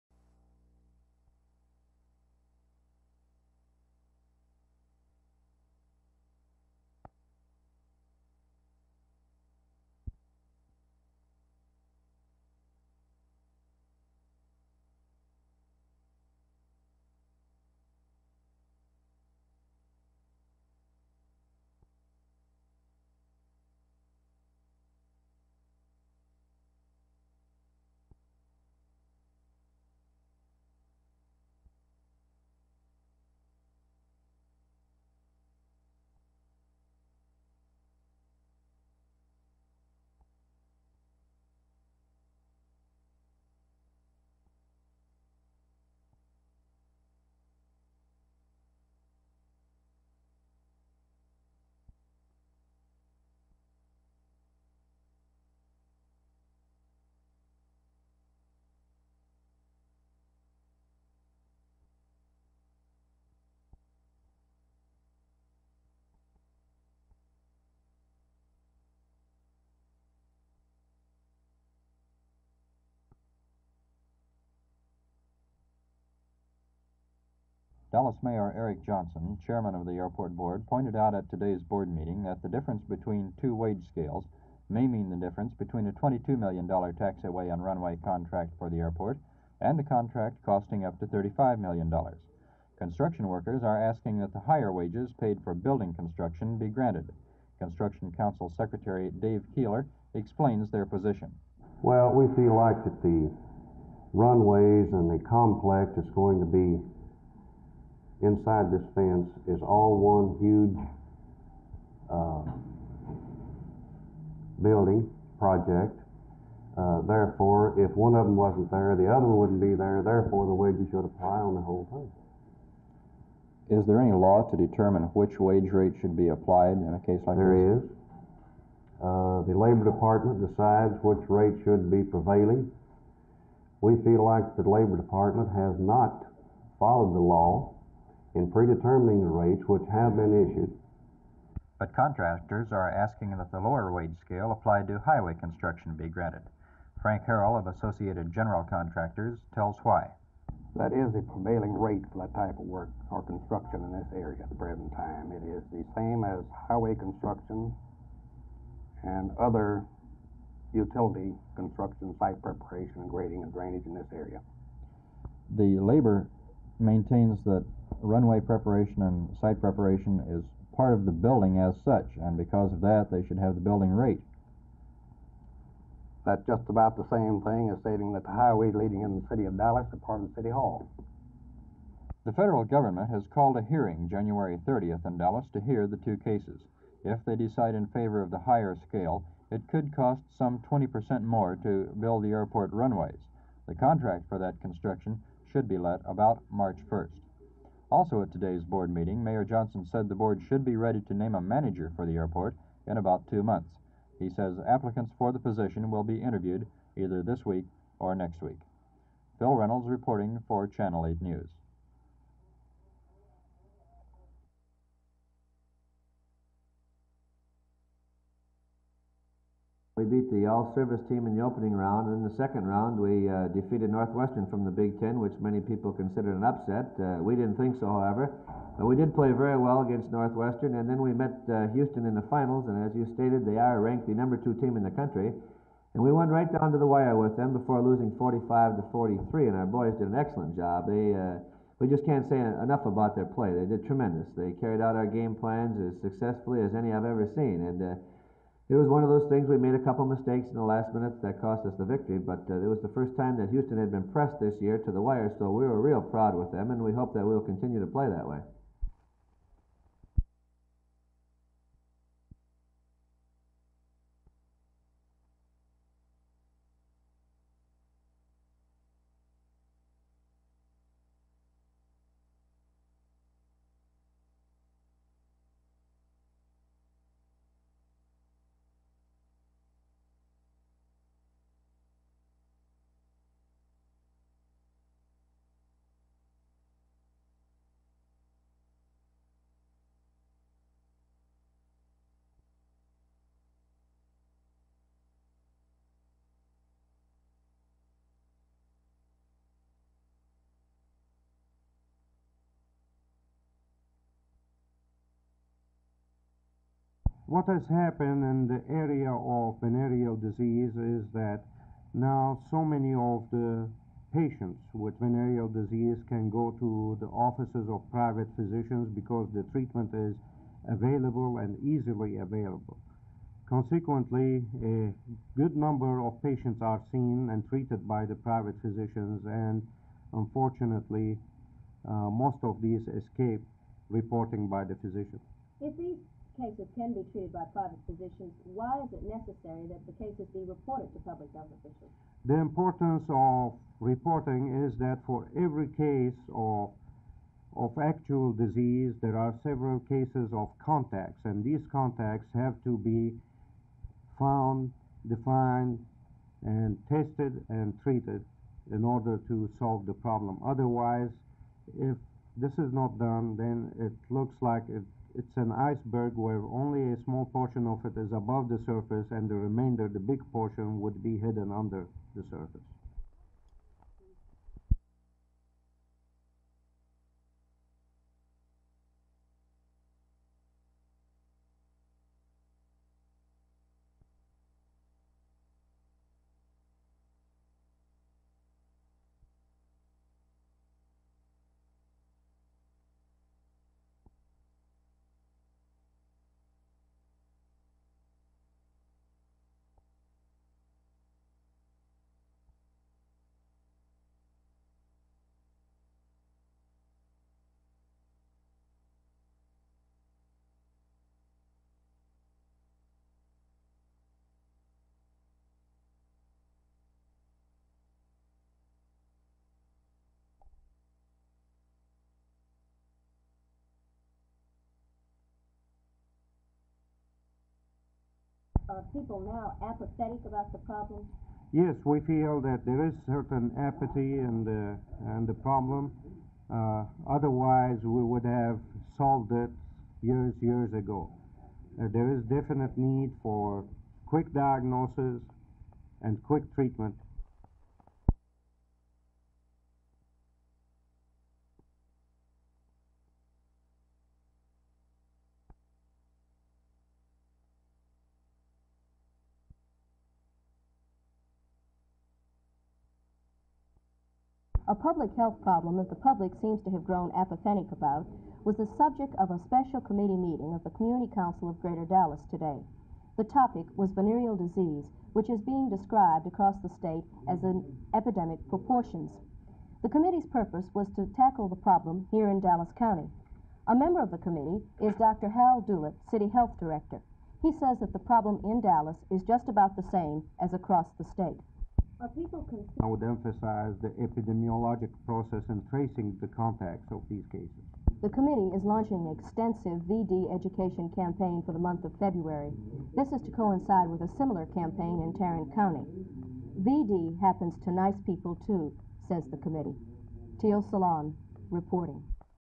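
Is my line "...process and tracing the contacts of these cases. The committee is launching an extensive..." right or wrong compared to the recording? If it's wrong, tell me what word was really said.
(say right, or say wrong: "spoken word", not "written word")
right.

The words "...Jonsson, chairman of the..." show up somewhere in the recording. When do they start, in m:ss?
1:18.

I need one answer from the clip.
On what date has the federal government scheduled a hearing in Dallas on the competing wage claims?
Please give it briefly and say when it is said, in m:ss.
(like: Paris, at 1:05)
January 30th, at 3:04.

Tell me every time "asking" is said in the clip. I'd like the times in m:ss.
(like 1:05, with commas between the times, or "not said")
1:33, 2:22.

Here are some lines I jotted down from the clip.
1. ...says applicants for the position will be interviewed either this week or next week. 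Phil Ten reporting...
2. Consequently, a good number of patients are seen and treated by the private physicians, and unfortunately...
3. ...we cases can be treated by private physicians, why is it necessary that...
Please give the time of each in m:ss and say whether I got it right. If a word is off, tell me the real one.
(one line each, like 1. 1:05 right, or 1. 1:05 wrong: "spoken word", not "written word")
1. 3:24 wrong: "Reynolds", not "Ten"
2. 5:23 right
3. 5:35 right.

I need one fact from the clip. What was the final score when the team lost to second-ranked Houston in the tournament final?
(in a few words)
45 to 43.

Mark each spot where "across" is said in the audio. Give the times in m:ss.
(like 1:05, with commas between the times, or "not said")
7:56, 8:10.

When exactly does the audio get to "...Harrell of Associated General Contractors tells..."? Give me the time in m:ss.
2:27.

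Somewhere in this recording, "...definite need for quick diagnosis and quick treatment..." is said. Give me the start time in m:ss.
7:22.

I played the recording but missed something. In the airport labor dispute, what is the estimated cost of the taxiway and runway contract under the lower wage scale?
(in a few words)
$22 million.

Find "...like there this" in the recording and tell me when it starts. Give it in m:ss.
2:07.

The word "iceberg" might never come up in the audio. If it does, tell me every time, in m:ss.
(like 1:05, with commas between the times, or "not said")
6:05.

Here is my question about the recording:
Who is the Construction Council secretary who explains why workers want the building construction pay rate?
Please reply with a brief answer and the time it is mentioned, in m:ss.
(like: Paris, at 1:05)
Dave Keeler, at 1:39.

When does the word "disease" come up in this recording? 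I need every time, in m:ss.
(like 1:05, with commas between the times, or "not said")
5:10, 5:15, 5:48, 7:54.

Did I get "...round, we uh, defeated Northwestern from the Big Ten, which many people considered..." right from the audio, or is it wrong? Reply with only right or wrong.
right.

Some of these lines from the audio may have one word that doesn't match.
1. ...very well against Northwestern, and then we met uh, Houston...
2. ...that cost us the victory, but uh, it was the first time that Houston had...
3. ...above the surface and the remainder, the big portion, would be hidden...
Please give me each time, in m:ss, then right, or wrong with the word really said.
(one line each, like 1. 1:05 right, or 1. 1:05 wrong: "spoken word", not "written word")
1. 3:49 right
2. 4:11 right
3. 6:08 right.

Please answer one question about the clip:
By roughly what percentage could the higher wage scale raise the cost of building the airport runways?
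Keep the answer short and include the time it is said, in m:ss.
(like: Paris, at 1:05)
20%, at 3:10.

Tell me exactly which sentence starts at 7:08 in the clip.
are people now apathetic about the problem?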